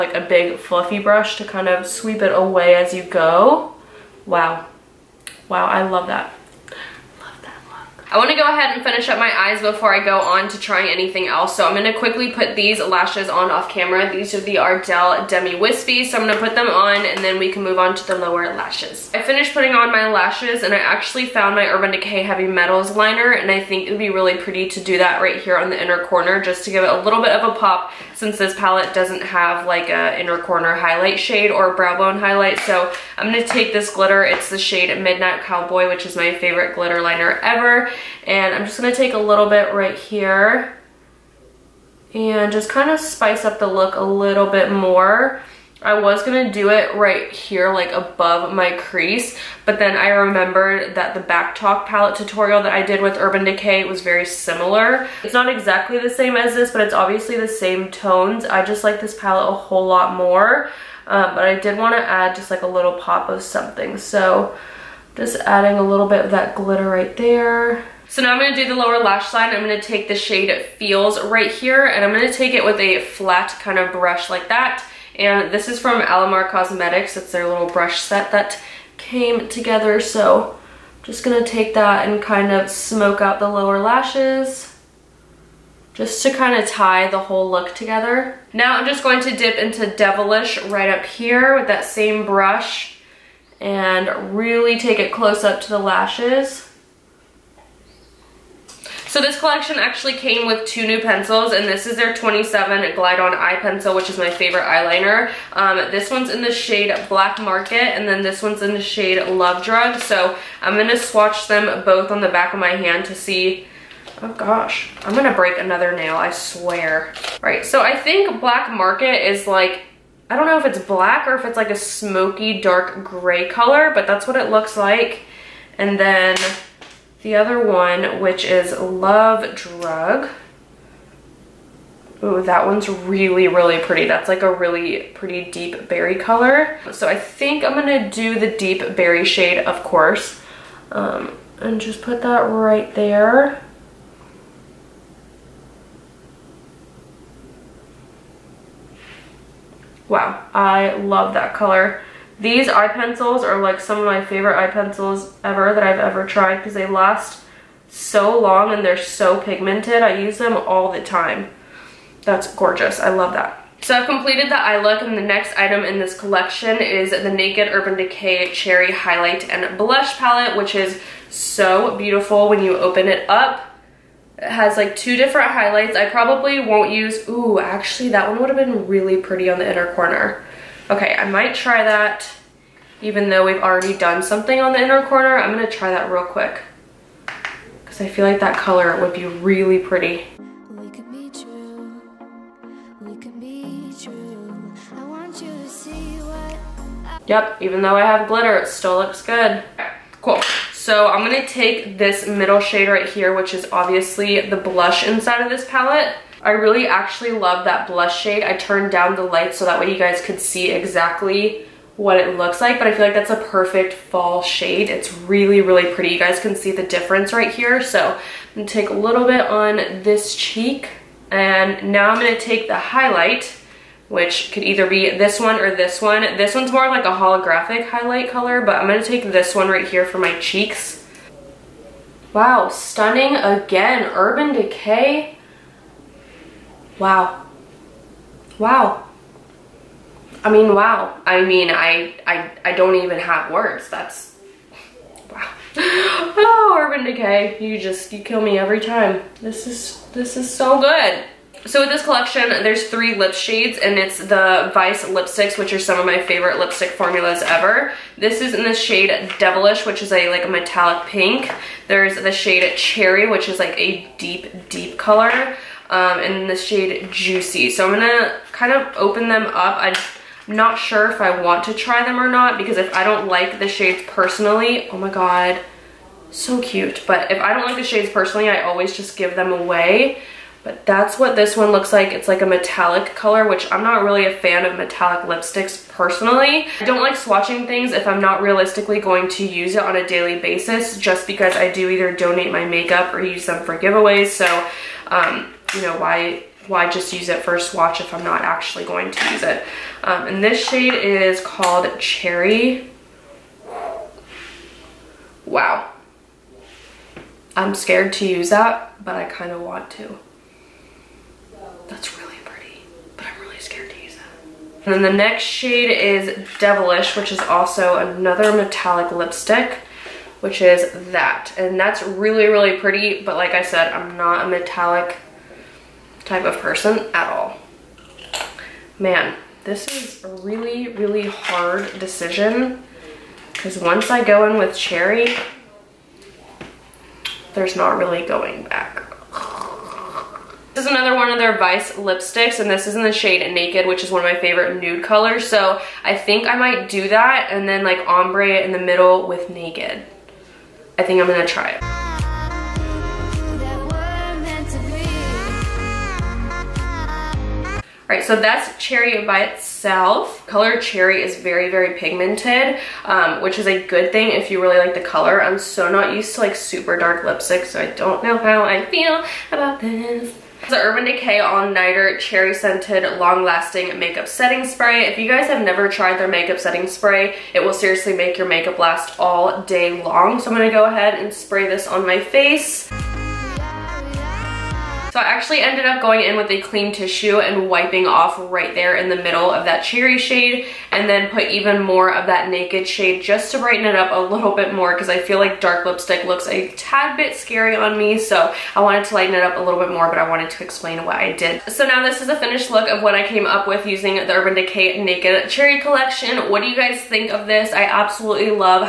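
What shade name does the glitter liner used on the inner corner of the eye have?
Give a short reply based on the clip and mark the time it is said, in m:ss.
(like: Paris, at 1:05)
Midnight Cowboy, at 0:34.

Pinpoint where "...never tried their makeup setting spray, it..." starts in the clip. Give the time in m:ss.
6:15.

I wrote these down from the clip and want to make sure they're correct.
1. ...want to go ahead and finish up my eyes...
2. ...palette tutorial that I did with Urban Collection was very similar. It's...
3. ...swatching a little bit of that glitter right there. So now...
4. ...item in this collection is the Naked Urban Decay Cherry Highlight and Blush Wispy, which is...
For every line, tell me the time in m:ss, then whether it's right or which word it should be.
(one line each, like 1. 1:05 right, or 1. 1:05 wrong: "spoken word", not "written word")
1. 0:08 right
2. 0:51 wrong: "Decay", not "Collection"
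3. 1:05 wrong: "adding", not "swatching"
4. 2:45 wrong: "Palette", not "Wispy".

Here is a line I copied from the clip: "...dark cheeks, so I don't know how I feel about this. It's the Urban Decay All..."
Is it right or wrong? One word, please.
wrong.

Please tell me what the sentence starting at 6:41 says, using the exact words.
So now this is a finished look of what I came up with using the Urban Decay Naked Cherry Collection.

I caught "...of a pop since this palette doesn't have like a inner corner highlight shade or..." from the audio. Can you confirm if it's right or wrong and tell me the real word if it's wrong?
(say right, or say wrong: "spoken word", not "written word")
right.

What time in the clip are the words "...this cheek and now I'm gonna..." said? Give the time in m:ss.
3:40.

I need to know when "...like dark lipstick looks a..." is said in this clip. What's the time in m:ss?
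6:35.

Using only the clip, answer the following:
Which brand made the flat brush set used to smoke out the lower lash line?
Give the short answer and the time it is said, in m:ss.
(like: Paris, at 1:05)
Alamar Cosmetics, at 1:15.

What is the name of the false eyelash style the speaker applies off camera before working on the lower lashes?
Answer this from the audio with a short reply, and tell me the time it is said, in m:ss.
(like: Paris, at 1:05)
Ardell Demi Wispy, at 0:14.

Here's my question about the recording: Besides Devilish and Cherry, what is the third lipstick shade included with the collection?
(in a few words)
Juicy.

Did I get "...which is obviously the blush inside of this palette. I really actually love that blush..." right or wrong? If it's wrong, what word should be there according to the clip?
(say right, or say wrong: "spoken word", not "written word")
right.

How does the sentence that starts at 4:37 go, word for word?
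But if I don't like the shades personally, I always just give them away.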